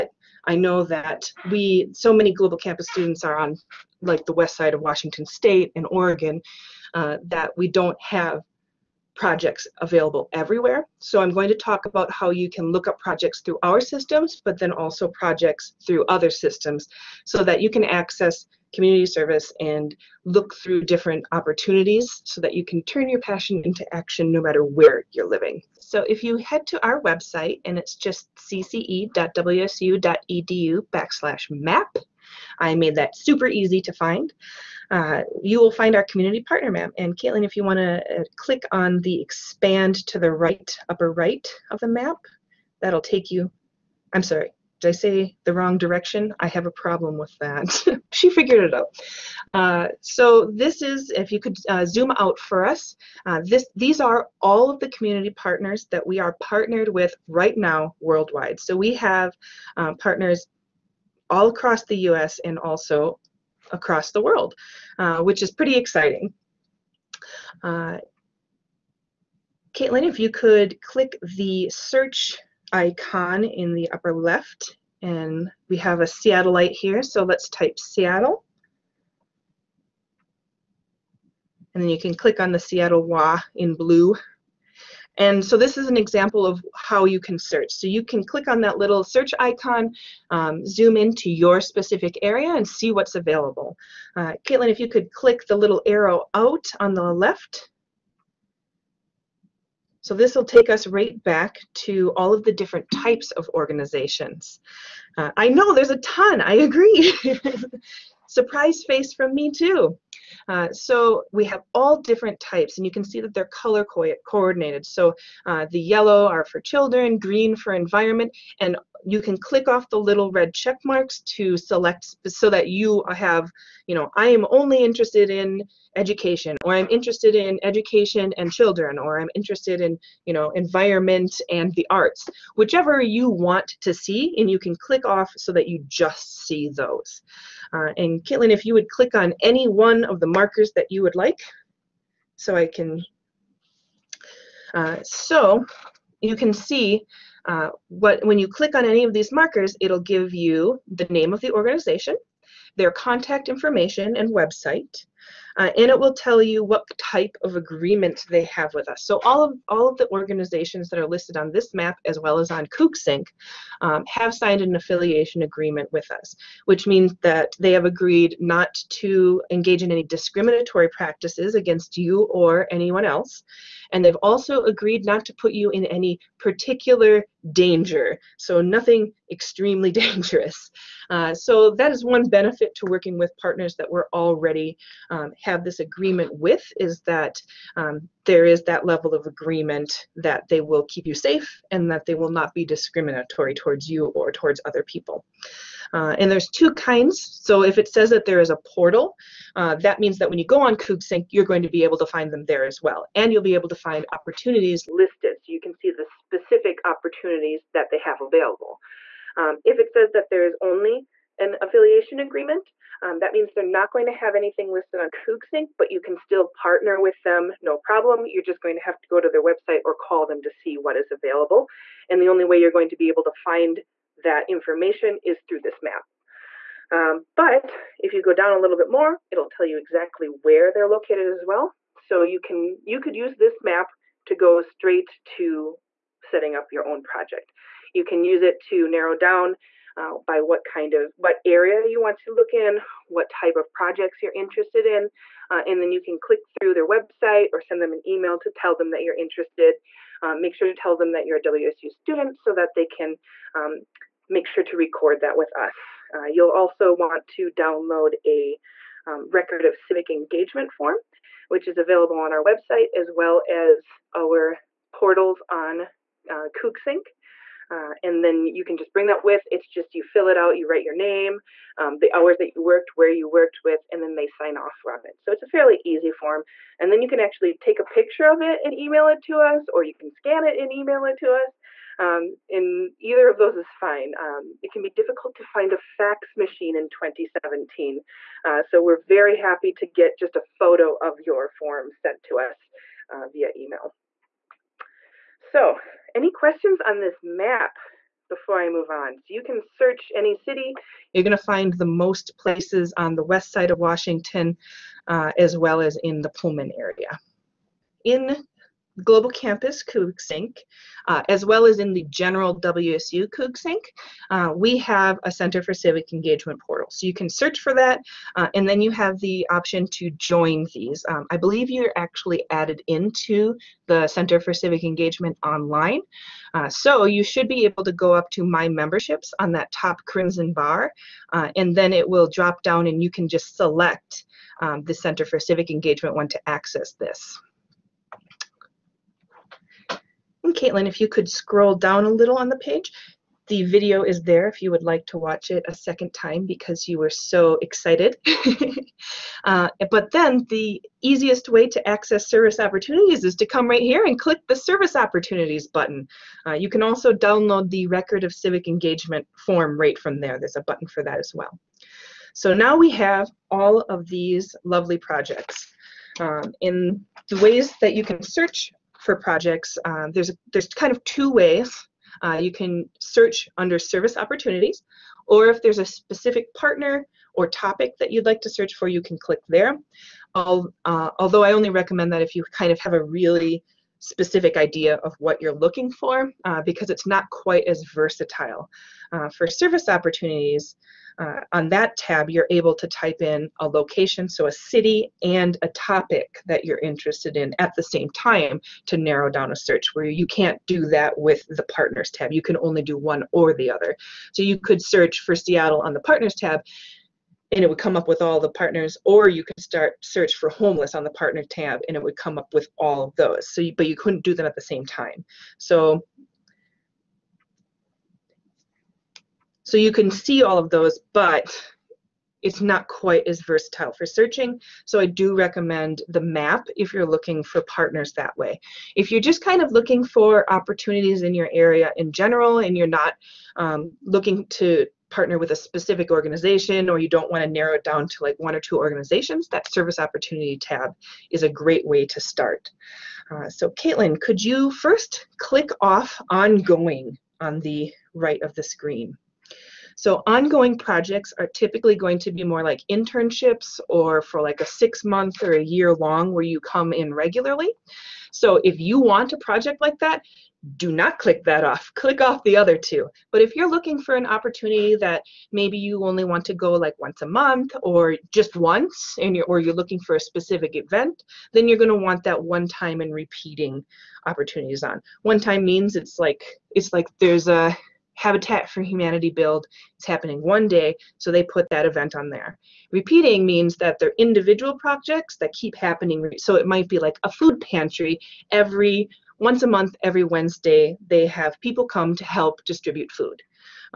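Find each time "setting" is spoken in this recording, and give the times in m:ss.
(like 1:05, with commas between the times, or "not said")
3:56.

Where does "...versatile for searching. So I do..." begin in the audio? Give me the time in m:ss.
7:03.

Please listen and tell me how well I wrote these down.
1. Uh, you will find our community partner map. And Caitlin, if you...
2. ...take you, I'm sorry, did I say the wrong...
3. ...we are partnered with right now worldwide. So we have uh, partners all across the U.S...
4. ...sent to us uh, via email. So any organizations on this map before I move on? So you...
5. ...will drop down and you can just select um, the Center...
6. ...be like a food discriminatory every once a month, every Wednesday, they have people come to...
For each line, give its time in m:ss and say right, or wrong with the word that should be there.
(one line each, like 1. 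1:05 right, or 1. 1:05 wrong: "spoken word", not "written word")
1. 0:34 right
2. 0:43 right
3. 0:56 right
4. 4:51 wrong: "questions", not "organizations"
5. 5:32 right
6. 8:06 wrong: "pantry", not "discriminatory".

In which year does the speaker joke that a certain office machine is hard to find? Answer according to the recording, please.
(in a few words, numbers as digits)
2017.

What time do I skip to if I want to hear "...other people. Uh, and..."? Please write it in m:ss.
3:14.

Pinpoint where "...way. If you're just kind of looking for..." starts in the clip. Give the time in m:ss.
7:08.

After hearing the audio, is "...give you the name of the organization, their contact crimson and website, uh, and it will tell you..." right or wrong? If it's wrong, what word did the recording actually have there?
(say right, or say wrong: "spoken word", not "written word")
wrong: "information", not "crimson".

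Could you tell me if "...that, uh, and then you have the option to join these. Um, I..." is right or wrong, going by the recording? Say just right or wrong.
right.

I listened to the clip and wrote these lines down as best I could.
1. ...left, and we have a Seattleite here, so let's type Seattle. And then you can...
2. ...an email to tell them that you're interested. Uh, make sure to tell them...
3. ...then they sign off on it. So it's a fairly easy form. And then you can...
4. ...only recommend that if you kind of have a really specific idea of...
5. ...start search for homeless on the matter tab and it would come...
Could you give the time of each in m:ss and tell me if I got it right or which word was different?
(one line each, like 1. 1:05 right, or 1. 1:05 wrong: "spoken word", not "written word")
1. 1:14 right
2. 4:07 right
3. 4:34 right
4. 6:21 right
5. 6:49 wrong: "partner", not "matter".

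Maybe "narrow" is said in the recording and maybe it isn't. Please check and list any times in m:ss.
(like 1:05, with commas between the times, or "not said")
3:58, 6:38, 7:17.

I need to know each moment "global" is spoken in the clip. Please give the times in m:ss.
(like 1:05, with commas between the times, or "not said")
0:02, 5:09.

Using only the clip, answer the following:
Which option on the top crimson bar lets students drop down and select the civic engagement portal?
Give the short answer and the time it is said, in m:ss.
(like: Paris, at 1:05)
My Memberships, at 5:28.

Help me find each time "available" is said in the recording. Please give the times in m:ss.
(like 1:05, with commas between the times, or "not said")
0:09, 1:33, 3:28, 3:41, 4:21.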